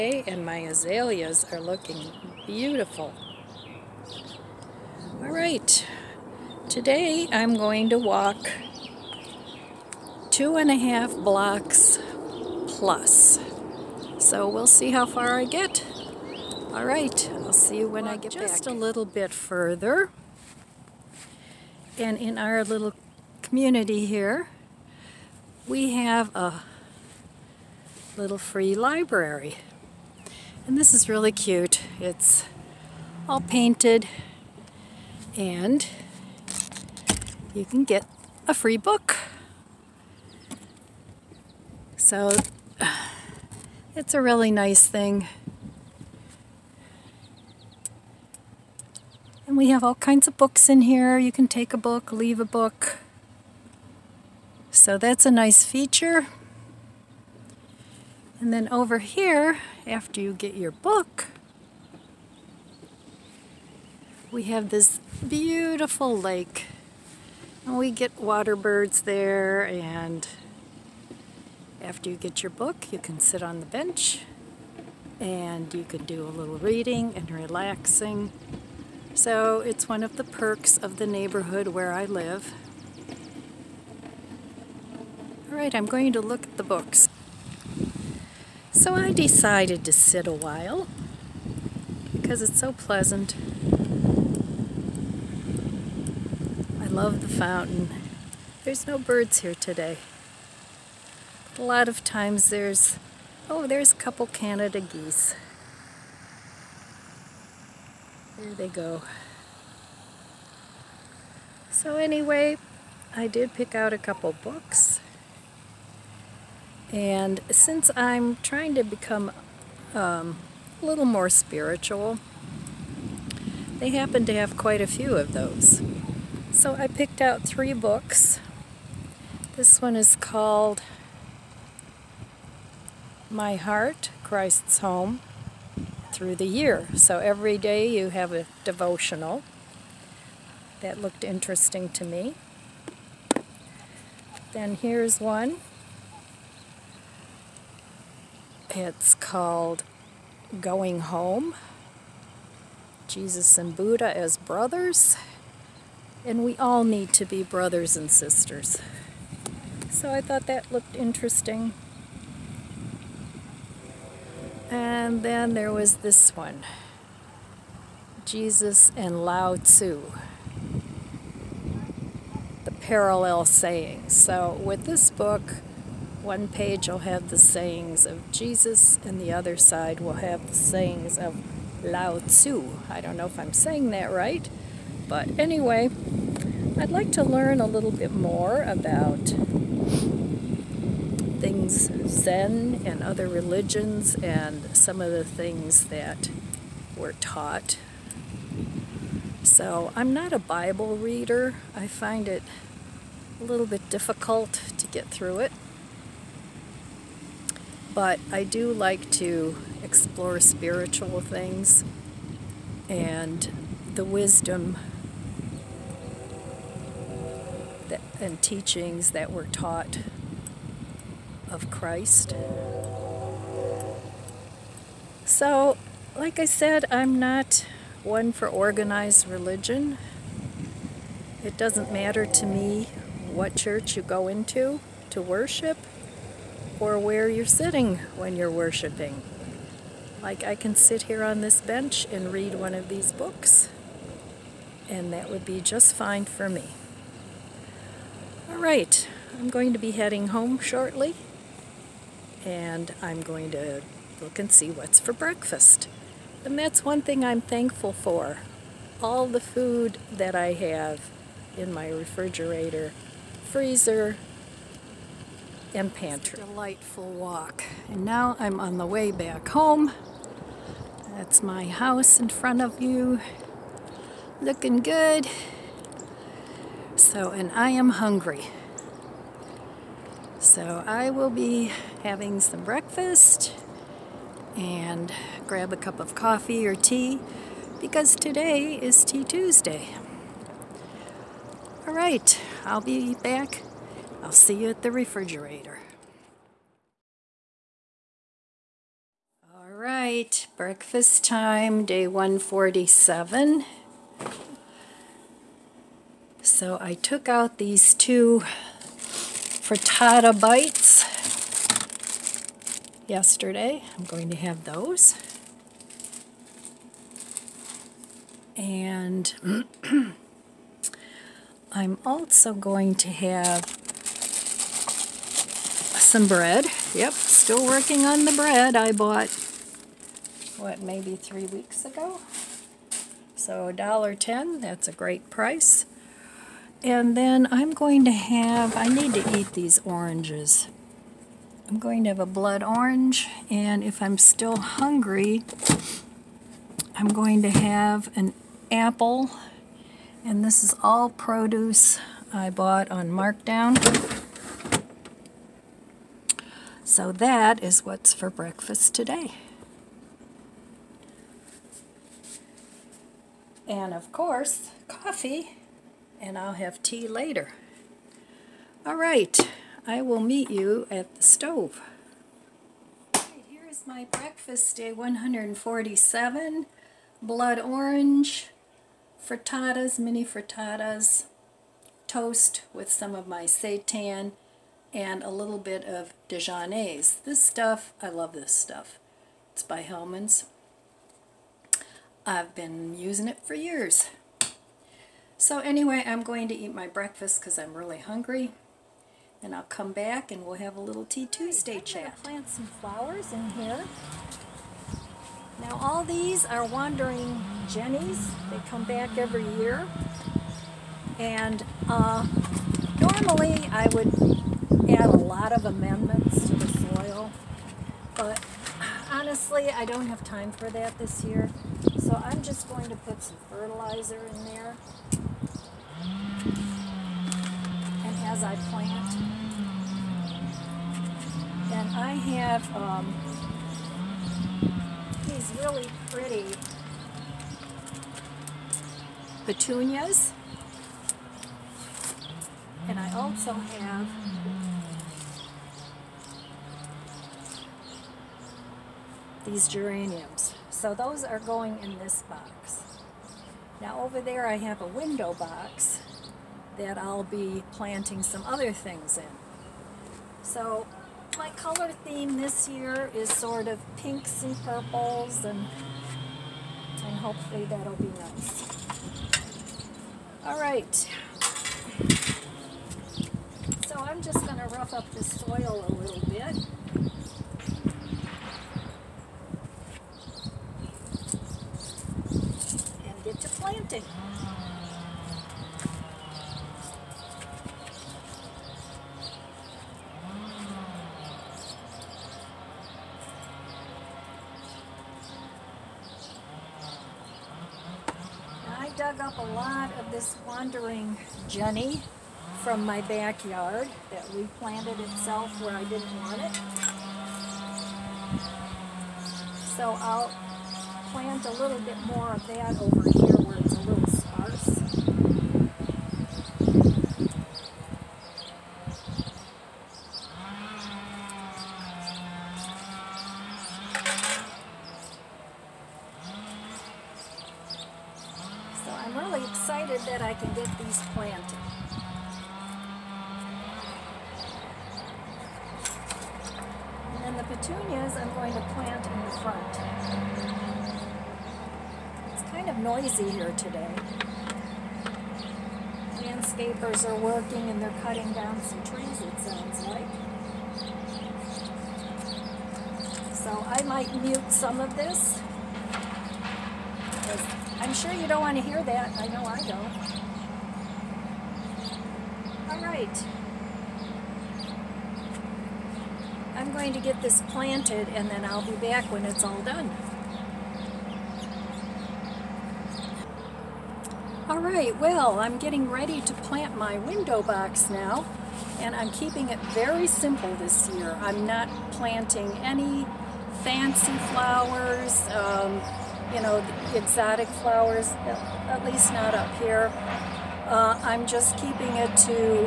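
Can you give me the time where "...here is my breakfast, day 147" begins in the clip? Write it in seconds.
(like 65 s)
373 s.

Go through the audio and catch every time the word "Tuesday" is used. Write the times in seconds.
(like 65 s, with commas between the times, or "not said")
289 s, 401 s.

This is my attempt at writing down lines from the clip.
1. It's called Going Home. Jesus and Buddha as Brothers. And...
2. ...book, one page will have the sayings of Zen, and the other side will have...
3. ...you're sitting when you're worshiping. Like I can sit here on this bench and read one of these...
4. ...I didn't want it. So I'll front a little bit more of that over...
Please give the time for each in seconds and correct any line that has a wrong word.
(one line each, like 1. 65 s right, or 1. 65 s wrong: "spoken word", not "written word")
1. 148 s right
2. 175 s wrong: "Jesus", not "Zen"
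3. 237 s right
4. 505 s wrong: "plant", not "front".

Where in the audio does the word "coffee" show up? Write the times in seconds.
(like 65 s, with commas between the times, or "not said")
286 s, 364 s.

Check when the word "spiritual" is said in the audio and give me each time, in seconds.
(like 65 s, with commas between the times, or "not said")
121 s, 210 s.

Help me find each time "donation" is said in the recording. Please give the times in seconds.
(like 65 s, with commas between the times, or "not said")
not said.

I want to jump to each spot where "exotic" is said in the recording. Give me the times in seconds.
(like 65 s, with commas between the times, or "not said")
586 s.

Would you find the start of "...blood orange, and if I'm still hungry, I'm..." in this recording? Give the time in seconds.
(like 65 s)
342 s.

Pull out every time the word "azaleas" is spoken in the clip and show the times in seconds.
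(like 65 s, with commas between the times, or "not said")
0 s.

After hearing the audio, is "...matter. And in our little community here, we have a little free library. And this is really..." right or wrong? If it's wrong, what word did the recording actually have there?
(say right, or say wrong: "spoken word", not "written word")
wrong: "further", not "matter".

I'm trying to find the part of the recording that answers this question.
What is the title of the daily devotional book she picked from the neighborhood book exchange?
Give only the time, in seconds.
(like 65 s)
133 s.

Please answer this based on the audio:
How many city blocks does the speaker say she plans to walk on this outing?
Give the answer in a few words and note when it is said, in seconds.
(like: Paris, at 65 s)
2.5 blocks plus, at 10 s.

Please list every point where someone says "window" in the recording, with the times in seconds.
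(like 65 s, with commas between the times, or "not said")
454 s, 576 s.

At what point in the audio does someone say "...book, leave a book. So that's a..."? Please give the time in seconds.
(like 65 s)
51 s.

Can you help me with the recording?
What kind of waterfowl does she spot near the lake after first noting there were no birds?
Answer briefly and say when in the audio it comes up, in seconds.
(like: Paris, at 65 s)
Canada geese, at 104 s.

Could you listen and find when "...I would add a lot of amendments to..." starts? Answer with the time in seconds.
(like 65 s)
413 s.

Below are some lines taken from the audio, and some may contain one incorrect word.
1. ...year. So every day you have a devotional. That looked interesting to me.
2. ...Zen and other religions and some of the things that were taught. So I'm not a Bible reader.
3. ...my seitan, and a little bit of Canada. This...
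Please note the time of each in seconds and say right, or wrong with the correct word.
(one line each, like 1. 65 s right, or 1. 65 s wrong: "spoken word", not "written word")
1. 136 s right
2. 192 s right
3. 383 s wrong: "Dijonnaise", not "Canada".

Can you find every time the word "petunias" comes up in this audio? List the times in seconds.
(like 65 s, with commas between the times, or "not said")
439 s, 537 s.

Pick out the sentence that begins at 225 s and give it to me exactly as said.
So, like I said, I'm not one for organized religion.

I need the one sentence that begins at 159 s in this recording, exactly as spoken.
So I thought that looked interesting.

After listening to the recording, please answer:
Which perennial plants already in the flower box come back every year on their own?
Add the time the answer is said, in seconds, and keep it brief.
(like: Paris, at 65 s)
wandering jennies, at 406 s.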